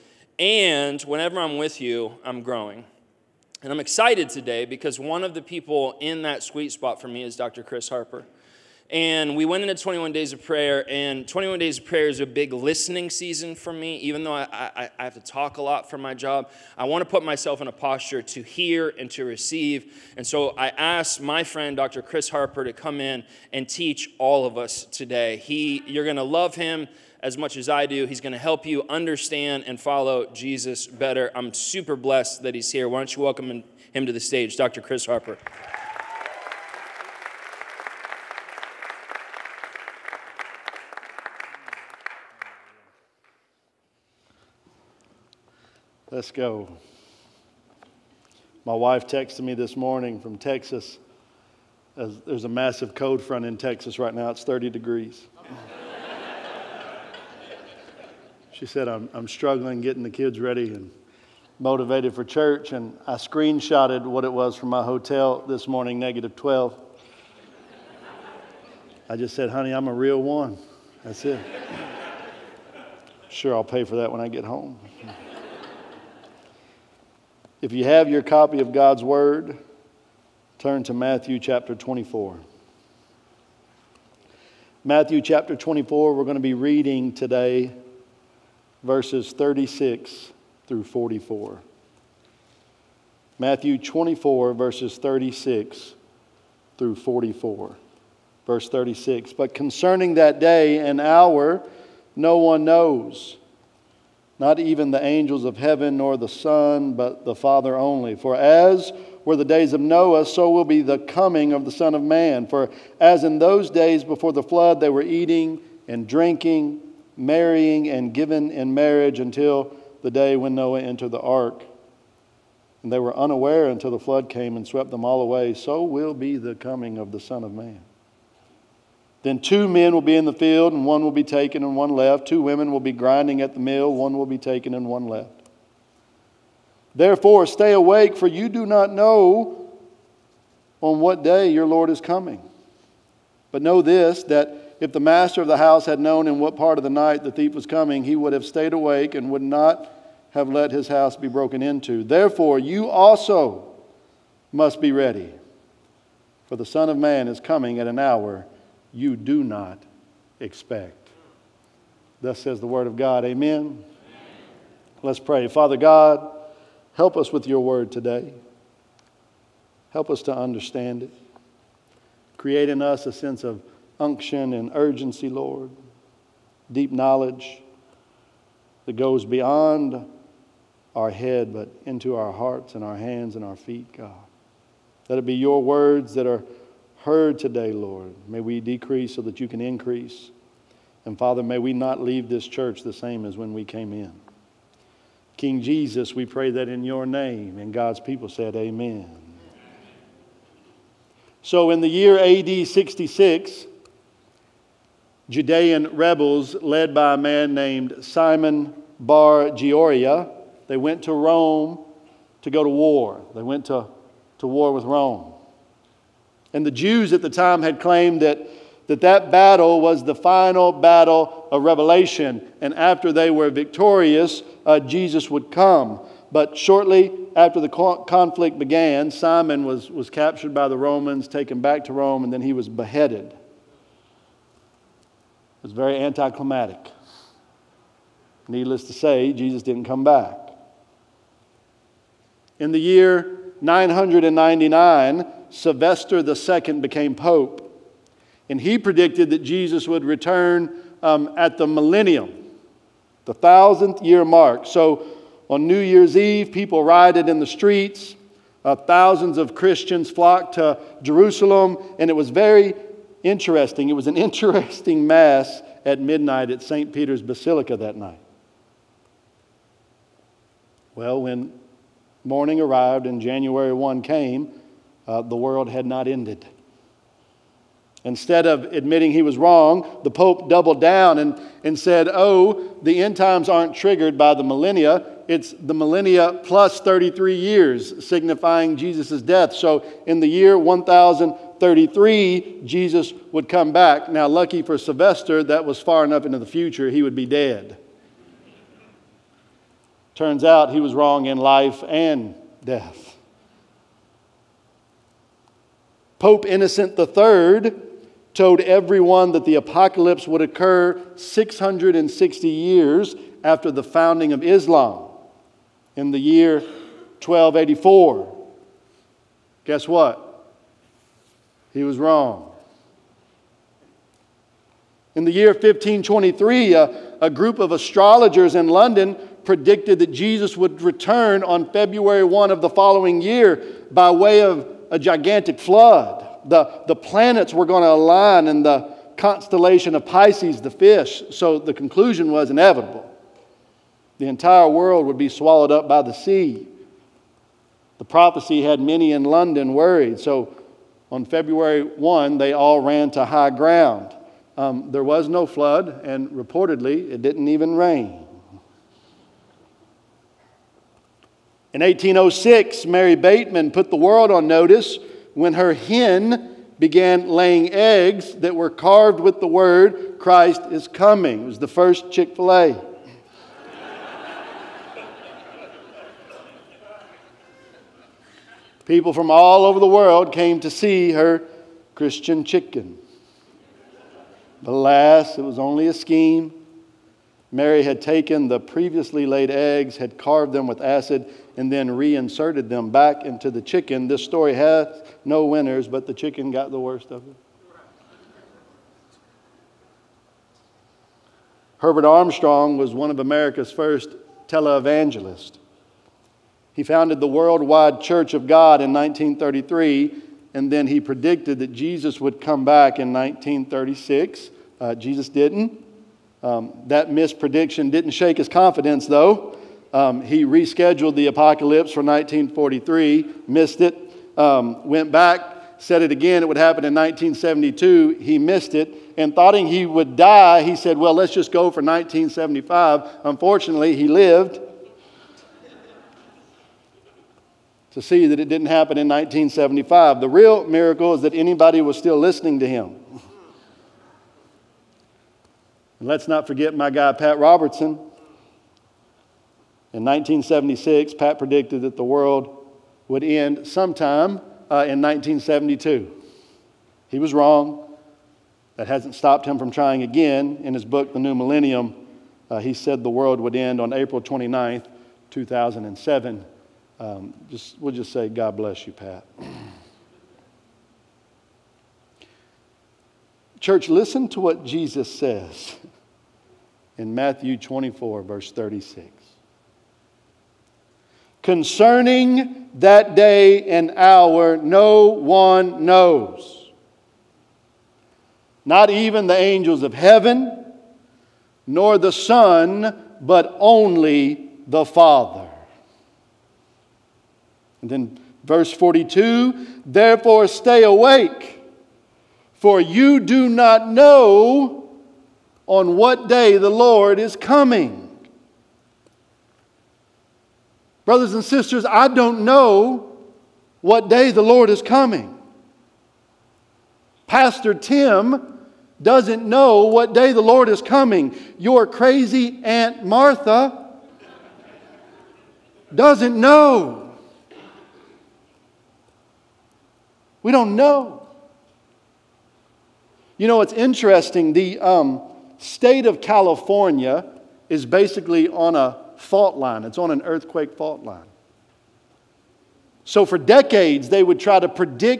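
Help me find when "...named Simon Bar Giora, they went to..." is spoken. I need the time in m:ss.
3:27.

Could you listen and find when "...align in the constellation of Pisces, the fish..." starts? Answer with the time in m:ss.
5:37.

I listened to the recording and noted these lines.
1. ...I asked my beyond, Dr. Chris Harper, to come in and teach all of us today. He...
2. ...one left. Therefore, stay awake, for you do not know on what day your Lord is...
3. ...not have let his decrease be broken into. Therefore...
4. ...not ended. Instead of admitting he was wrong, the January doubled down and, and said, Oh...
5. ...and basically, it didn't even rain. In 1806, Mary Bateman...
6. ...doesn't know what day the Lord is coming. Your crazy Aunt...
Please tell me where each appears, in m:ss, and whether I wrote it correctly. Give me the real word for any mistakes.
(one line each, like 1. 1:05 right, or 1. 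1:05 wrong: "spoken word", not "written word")
1. 0:20 wrong: "friend", not "beyond"
2. 2:14 right
3. 2:29 wrong: "house", not "decrease"
4. 4:35 wrong: "Pope", not "January"
5. 5:56 wrong: "reportedly", not "basically"
6. 8:39 right.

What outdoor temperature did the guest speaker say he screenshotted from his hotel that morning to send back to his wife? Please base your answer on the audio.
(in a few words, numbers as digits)
-12.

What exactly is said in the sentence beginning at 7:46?
Um, just, we'll just say, God bless you, Pat.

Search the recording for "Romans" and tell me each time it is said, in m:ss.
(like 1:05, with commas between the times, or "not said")
3:50.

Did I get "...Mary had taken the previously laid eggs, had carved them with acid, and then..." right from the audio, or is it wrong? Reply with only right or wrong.
right.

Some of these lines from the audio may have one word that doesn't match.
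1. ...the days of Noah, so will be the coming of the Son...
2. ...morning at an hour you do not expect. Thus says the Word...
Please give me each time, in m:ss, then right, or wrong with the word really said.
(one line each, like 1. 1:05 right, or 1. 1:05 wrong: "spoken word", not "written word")
1. 1:49 right
2. 2:37 wrong: "coming", not "morning".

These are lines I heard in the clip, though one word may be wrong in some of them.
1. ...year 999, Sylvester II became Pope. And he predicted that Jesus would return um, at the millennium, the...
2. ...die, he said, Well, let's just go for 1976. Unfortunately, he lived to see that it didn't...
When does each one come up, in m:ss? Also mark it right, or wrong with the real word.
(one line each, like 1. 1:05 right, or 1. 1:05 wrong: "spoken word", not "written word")
1. 4:02 right
2. 7:10 wrong: "1975", not "1976".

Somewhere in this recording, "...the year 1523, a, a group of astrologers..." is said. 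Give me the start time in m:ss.
5:25.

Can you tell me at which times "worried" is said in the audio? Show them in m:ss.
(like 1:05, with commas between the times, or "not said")
5:49.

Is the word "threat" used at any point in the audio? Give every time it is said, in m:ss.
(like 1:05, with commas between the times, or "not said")
not said.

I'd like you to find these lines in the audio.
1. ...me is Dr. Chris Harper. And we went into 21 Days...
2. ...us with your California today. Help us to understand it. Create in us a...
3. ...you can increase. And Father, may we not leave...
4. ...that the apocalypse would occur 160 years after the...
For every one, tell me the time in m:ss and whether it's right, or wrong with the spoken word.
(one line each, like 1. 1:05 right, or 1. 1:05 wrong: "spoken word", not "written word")
1. 0:07 right
2. 2:47 wrong: "Word", not "California"
3. 3:09 right
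4. 5:09 wrong: "660", not "160".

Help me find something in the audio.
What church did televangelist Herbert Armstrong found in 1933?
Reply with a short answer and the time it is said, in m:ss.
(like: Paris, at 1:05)
Worldwide Church of God, at 6:47.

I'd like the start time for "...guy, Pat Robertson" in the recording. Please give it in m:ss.
7:26.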